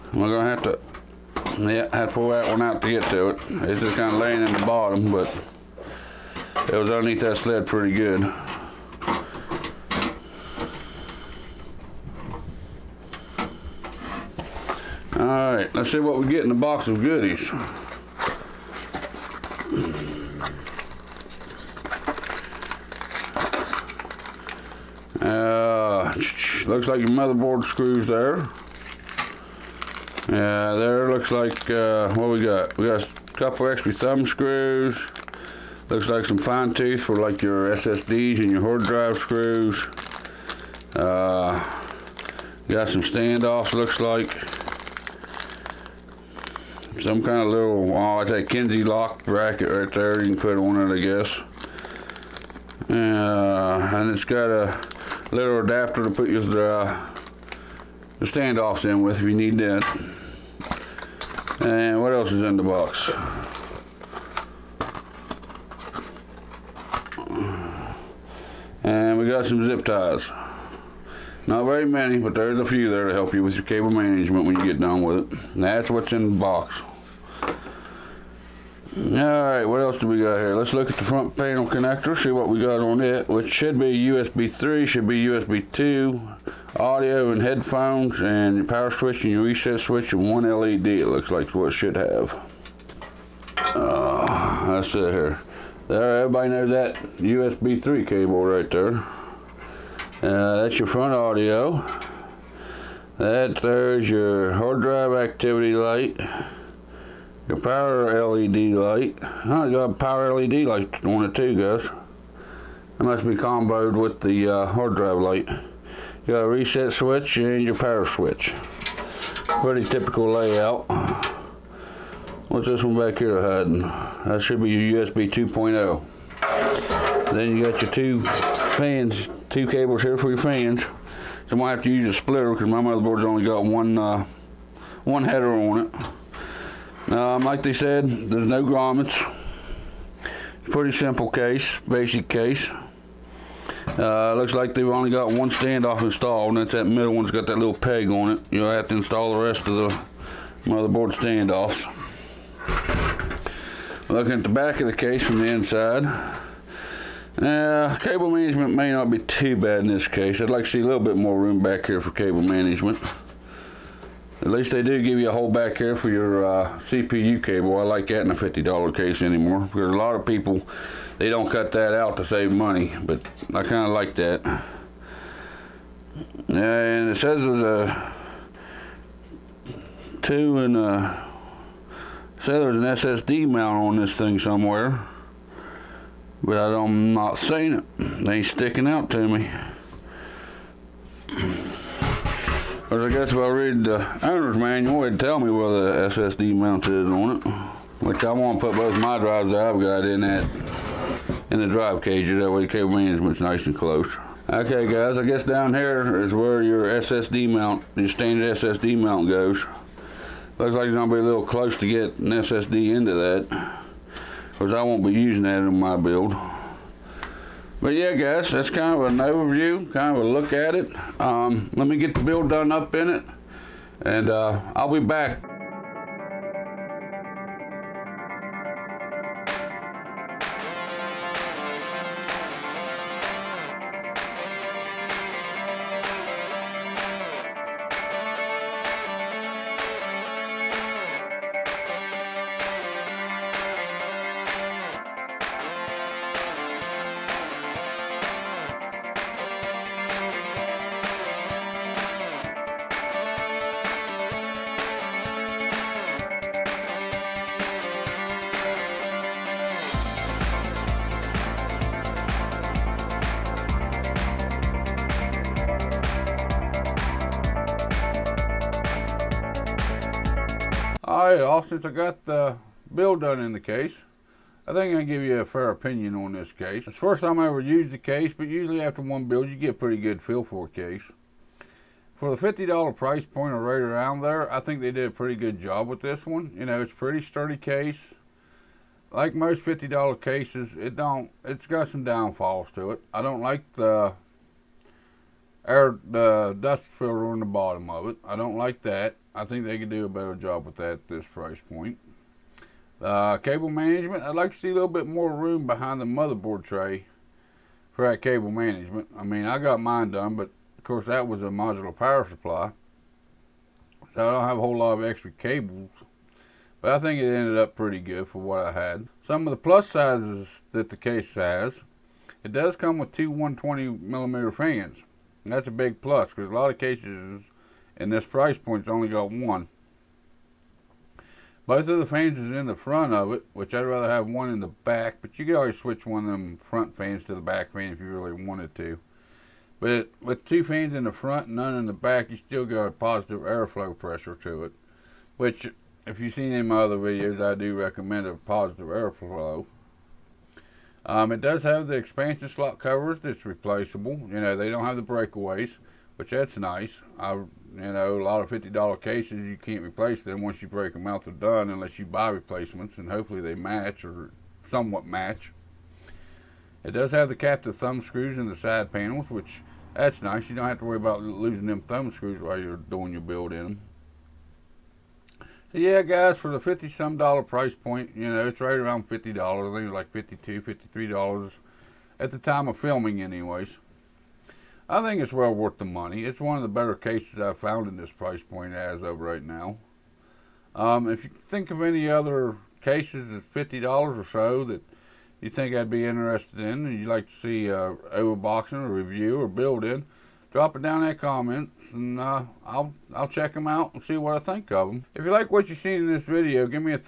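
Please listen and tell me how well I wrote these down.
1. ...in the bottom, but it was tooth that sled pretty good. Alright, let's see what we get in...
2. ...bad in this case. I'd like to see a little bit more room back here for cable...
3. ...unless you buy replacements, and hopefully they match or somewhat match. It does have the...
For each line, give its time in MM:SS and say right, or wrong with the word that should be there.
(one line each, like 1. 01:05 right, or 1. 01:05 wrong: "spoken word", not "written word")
1. 00:04 wrong: "underneath", not "tooth"
2. 02:39 right
3. 06:01 right.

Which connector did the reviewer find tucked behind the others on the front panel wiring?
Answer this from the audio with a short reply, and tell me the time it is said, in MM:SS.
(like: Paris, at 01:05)
USB 2.0, at 02:05.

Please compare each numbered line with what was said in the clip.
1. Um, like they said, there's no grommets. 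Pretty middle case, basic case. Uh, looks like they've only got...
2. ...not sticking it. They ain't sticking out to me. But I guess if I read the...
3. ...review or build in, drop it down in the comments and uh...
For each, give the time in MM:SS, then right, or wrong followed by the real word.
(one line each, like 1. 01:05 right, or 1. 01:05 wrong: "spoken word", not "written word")
1. 02:17 wrong: "simple", not "middle"
2. 03:07 wrong: "seeing", not "sticking"
3. 06:38 right.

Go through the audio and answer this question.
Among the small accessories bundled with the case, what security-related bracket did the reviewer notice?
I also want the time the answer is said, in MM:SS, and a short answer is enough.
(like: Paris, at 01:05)
Kinsey lock bracket, at 00:48.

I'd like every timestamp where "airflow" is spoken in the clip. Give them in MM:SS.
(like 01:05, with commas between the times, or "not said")
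05:43, 05:48.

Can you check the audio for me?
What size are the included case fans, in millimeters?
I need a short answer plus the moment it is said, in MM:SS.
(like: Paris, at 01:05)
120 millimeter, at 05:23.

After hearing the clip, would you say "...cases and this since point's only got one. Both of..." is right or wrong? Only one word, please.
wrong.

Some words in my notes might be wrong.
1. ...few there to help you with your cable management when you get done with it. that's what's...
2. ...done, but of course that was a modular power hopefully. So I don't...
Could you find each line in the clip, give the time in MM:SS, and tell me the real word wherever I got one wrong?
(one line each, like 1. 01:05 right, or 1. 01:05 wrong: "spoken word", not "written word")
1. 01:12 right
2. 05:10 wrong: "supply", not "hopefully".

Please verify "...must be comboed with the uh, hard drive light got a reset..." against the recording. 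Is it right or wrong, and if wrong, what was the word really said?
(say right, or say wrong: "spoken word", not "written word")
right.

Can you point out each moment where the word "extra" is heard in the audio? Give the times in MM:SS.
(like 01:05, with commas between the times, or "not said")
00:33, 05:15.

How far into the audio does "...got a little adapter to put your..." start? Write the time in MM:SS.
00:54.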